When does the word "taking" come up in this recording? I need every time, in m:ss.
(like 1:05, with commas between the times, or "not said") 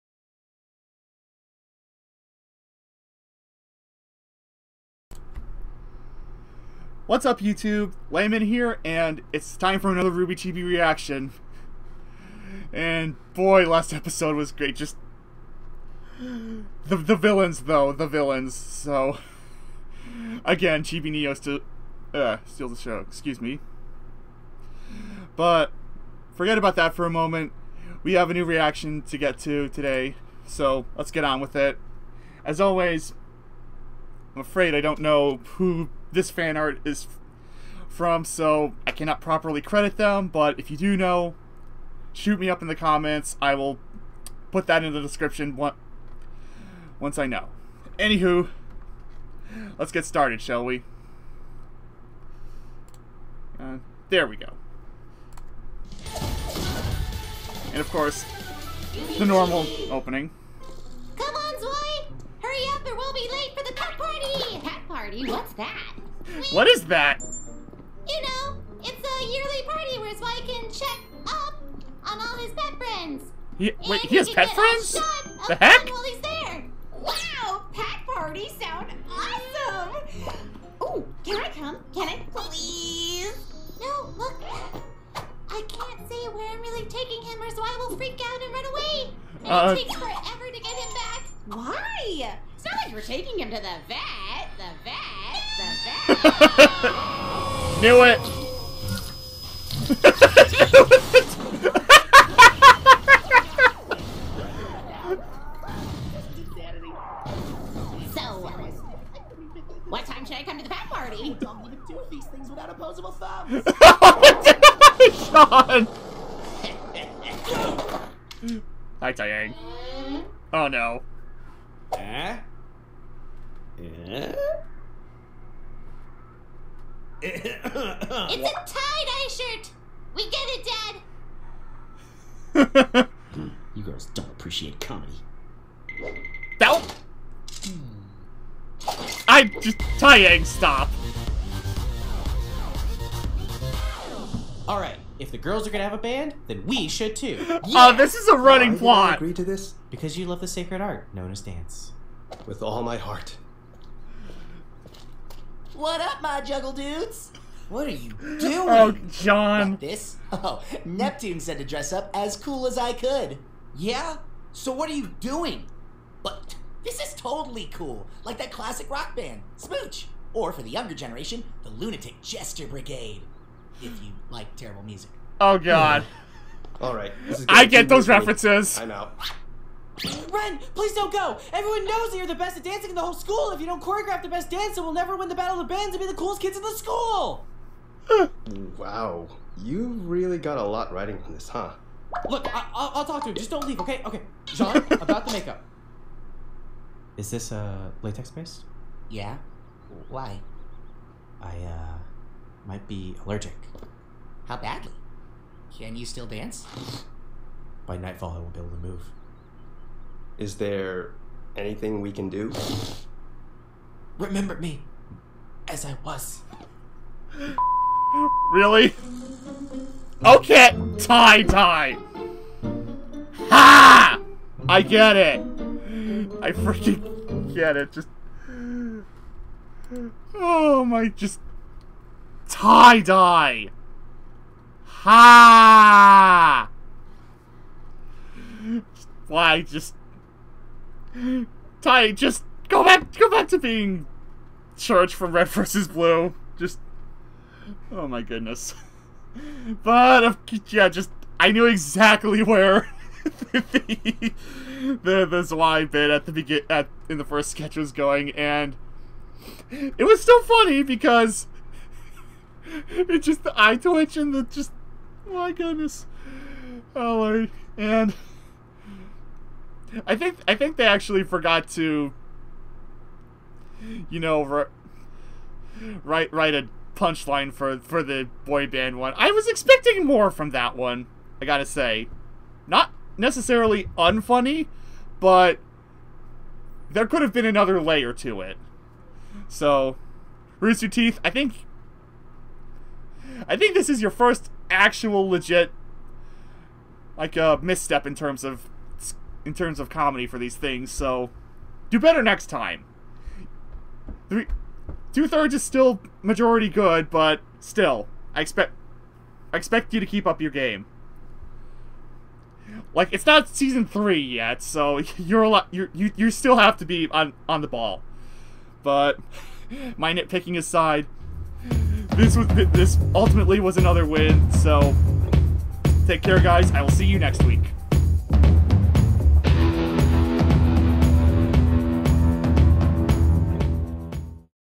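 1:26, 1:33.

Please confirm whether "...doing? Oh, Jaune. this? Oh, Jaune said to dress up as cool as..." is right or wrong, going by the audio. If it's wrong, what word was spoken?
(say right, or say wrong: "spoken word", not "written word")
wrong: "Neptune", not "Jaune".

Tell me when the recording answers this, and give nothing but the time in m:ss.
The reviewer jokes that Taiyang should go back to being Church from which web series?
4:05.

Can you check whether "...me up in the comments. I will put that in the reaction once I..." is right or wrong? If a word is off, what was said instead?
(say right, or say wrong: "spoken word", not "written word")
wrong: "description", not "reaction".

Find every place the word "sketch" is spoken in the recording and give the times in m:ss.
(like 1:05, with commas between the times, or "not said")
4:17.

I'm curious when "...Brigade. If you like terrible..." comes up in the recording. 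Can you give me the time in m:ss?
2:52.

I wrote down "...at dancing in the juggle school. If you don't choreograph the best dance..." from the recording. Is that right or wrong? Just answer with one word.
wrong.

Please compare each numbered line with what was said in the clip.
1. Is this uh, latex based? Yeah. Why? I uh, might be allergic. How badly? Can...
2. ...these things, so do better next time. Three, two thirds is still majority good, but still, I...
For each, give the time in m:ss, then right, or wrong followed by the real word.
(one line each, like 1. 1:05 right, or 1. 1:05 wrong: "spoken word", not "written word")
1. 3:17 right
2. 5:00 right.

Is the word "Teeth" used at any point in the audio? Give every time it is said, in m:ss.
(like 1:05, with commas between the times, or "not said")
4:50.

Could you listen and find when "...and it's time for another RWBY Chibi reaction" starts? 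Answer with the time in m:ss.
0:08.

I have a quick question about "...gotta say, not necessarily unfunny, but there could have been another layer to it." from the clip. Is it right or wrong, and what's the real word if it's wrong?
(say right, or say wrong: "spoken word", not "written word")
right.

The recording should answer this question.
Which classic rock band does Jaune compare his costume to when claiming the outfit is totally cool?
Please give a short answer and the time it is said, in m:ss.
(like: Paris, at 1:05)
Smooch, at 2:49.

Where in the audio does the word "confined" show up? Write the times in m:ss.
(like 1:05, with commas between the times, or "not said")
not said.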